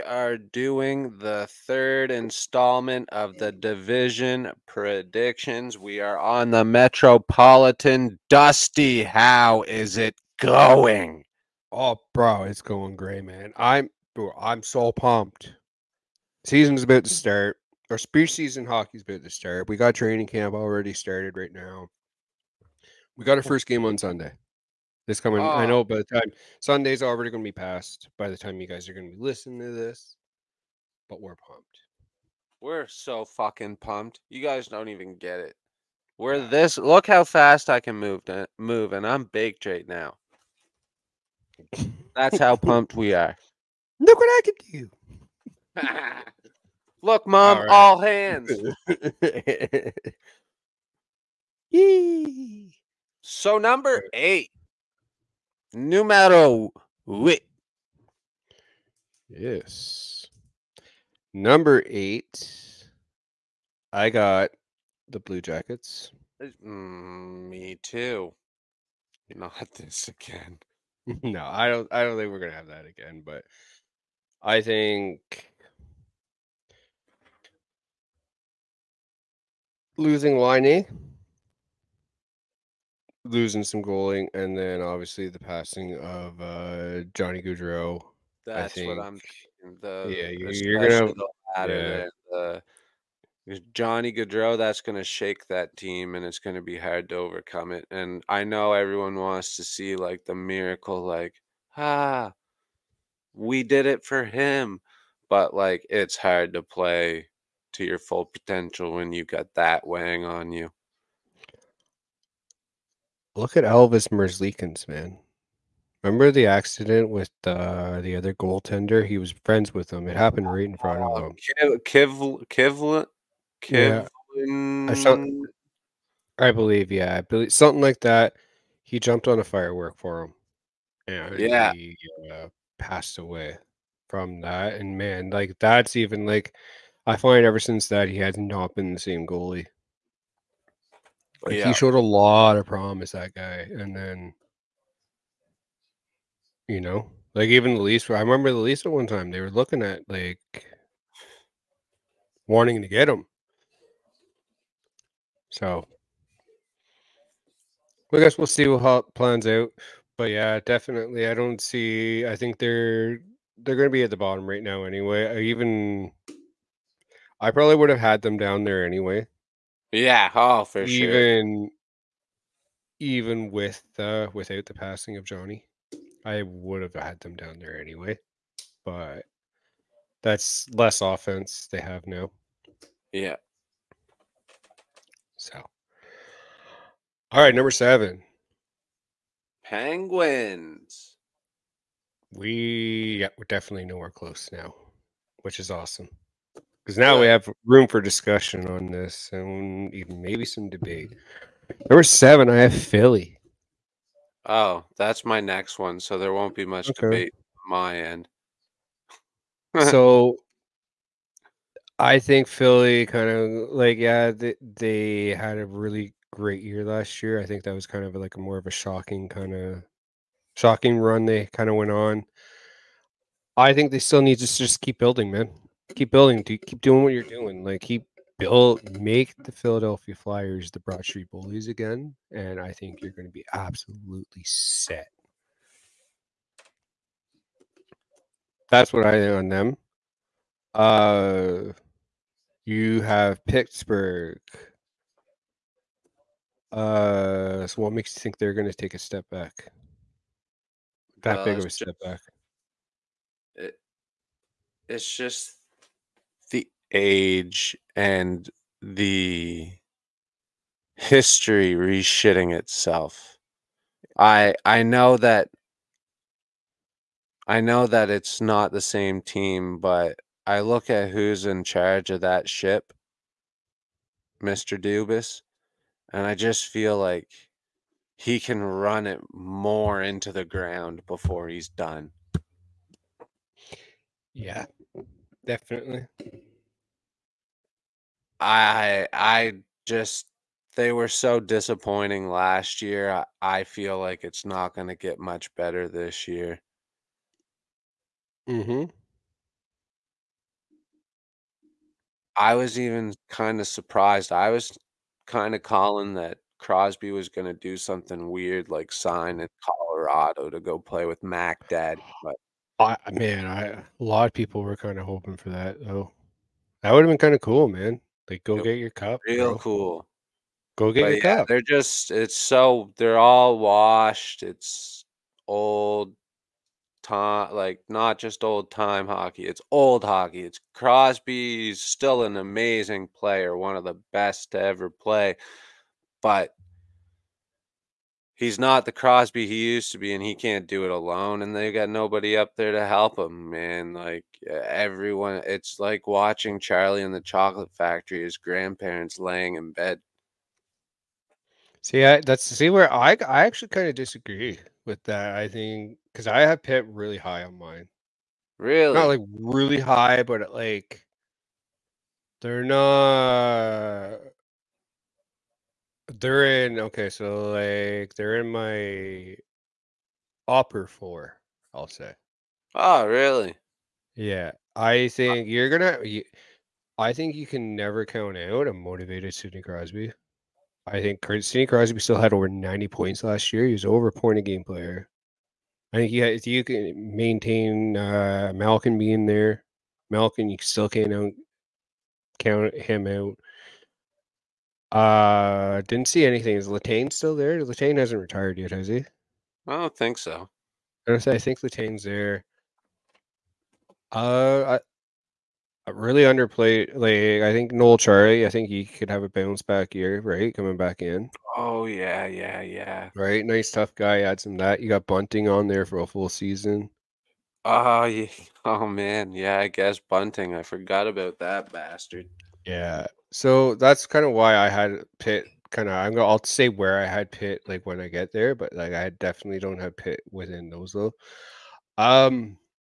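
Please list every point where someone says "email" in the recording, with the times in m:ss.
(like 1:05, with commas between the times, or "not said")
not said.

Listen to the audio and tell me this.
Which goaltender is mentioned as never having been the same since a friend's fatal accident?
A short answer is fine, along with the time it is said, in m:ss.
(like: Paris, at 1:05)
Elvis Merzlikins, at 1:53.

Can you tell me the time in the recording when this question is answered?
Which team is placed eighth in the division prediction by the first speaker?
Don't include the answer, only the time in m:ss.
1:05.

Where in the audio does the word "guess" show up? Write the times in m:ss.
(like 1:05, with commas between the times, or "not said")
2:38, 6:59.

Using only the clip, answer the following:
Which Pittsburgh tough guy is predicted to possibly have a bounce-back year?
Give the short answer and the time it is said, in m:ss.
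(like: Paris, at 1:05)
Noel Acciari, at 6:47.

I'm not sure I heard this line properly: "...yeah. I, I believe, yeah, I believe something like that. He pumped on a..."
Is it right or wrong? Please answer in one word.
wrong.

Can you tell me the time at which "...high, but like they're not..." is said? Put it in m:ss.
5:59.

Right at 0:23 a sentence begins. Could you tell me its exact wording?
We got our first game on Sunday.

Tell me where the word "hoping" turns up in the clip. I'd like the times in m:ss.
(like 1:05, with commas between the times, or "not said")
5:15.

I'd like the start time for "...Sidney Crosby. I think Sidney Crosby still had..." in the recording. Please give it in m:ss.
6:19.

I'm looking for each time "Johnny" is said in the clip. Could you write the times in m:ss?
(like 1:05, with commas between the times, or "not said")
1:27, 1:33, 2:55.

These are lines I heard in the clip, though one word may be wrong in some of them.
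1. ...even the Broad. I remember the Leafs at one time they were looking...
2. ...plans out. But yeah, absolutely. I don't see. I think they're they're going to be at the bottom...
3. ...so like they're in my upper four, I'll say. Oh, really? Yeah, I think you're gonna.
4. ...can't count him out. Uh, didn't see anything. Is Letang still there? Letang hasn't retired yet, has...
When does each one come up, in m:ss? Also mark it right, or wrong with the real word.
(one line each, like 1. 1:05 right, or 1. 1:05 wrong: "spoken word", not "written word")
1. 2:27 wrong: "Leafs", not "Broad"
2. 2:39 wrong: "definitely", not "absolutely"
3. 6:07 right
4. 6:30 right.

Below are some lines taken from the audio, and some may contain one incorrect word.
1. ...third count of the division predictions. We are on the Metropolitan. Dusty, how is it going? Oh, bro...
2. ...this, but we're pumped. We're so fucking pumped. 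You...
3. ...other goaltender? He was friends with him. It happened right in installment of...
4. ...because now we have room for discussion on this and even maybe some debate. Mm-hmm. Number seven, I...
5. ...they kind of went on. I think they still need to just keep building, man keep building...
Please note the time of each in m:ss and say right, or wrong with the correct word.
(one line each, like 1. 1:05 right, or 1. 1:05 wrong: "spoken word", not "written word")
1. 0:01 wrong: "installment", not "count"
2. 0:29 right
3. 1:58 wrong: "front", not "installment"
4. 3:16 right
5. 3:41 right.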